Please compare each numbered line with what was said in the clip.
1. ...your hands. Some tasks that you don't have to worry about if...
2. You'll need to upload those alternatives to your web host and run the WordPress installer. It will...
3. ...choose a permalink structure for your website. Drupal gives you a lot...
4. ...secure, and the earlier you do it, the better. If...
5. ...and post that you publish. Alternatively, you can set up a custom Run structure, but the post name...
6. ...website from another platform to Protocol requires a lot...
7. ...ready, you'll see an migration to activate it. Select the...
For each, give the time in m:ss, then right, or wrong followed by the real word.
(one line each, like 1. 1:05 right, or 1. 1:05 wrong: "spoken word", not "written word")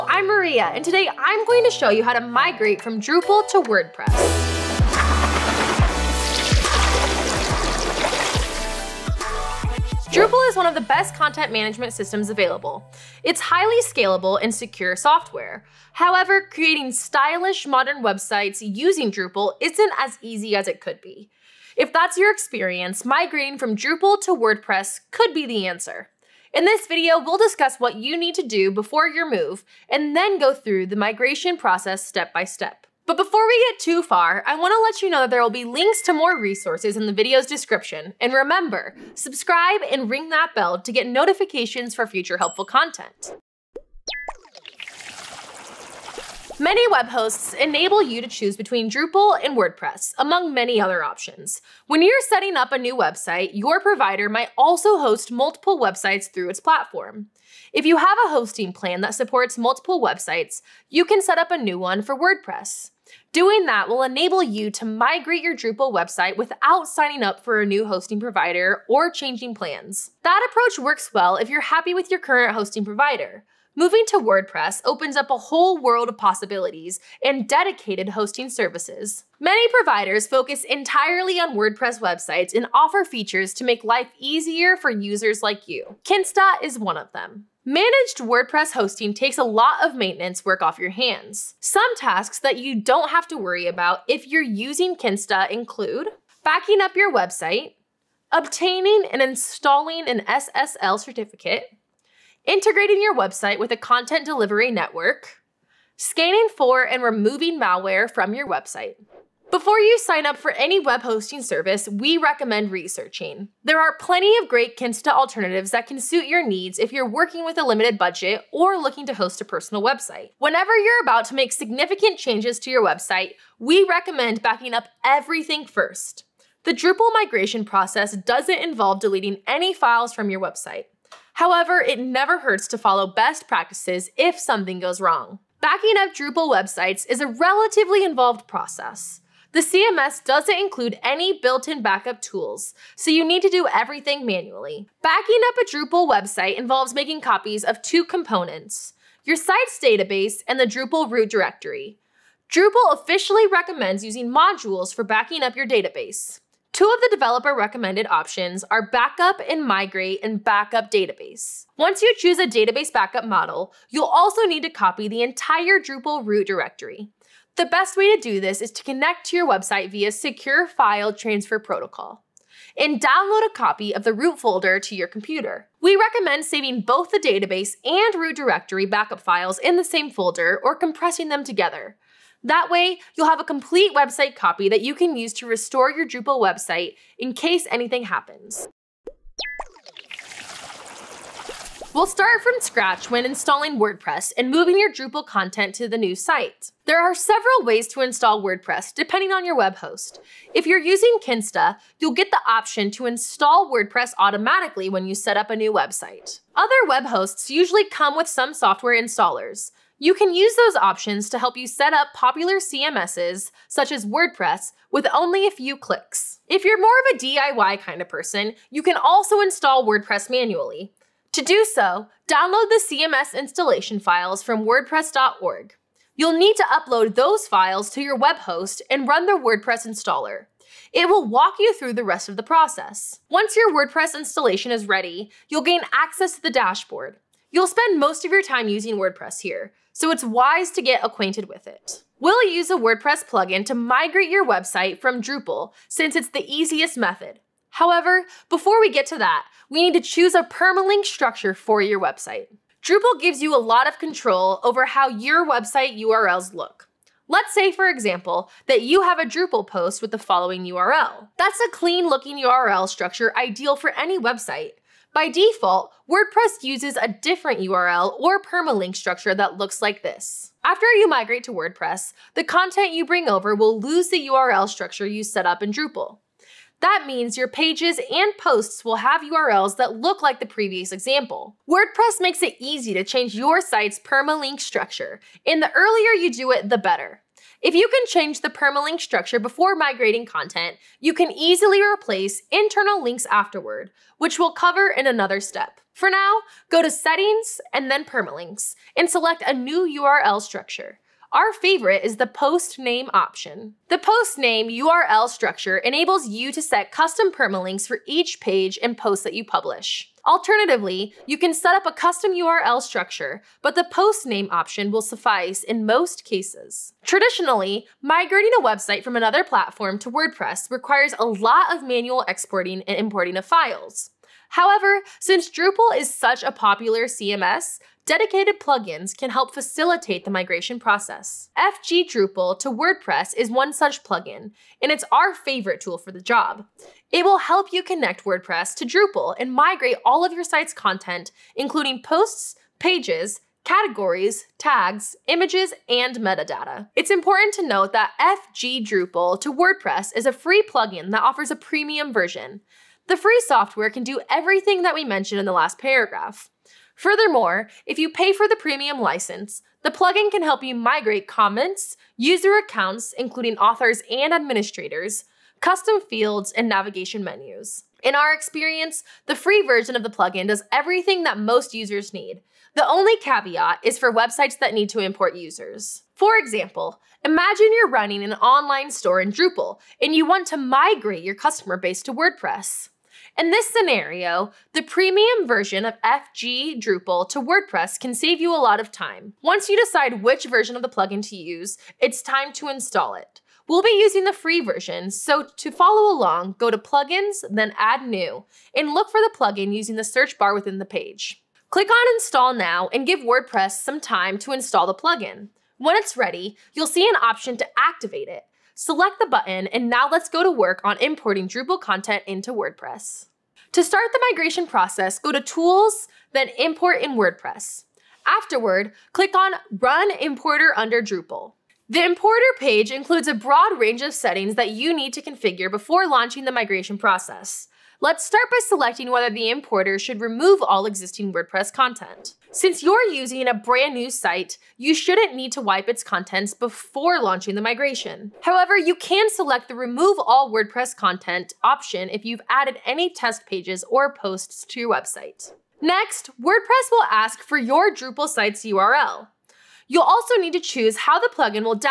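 1. 1:30 right
2. 3:46 wrong: "files", not "alternatives"
3. 4:10 right
4. 4:44 wrong: "structure", not "secure"
5. 5:08 wrong: "URL", not "Run"
6. 5:18 wrong: "WordPress", not "Protocol"
7. 6:46 wrong: "option", not "migration".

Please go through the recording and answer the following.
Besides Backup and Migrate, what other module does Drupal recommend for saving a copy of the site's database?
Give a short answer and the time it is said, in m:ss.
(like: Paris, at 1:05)
Backup Database, at 2:40.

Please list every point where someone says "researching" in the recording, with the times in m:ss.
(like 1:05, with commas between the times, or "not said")
1:52.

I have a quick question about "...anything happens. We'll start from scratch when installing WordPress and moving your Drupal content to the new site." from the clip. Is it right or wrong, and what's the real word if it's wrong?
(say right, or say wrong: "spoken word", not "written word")
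right.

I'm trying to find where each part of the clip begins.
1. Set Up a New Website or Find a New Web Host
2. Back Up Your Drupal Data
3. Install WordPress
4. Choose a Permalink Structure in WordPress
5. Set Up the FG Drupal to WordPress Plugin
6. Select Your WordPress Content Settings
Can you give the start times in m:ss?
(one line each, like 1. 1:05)
1. 0:49
2. 2:00
3. 3:17
4. 4:12
5. 5:16
6. 6:53.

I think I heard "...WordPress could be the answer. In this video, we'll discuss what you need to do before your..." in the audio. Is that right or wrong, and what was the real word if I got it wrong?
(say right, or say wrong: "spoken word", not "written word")
right.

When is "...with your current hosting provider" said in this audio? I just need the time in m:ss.
1:11.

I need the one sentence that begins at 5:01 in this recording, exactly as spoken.
Our favorite is the post name option.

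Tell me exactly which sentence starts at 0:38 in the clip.
And remember, subscribe and ring that bell to get notifications for future helpful content.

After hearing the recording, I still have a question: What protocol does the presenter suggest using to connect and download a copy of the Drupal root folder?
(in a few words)
Secure File Transfer Protocol.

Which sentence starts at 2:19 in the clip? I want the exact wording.
The CMS doesn't include any built-in backup tools, so you need to do everything manually.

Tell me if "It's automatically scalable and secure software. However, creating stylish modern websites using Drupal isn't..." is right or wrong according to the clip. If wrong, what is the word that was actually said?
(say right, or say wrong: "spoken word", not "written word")
wrong: "highly", not "automatically".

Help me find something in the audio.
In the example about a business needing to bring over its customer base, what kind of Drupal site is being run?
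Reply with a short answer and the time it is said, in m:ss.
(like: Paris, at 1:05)
online store, at 6:18.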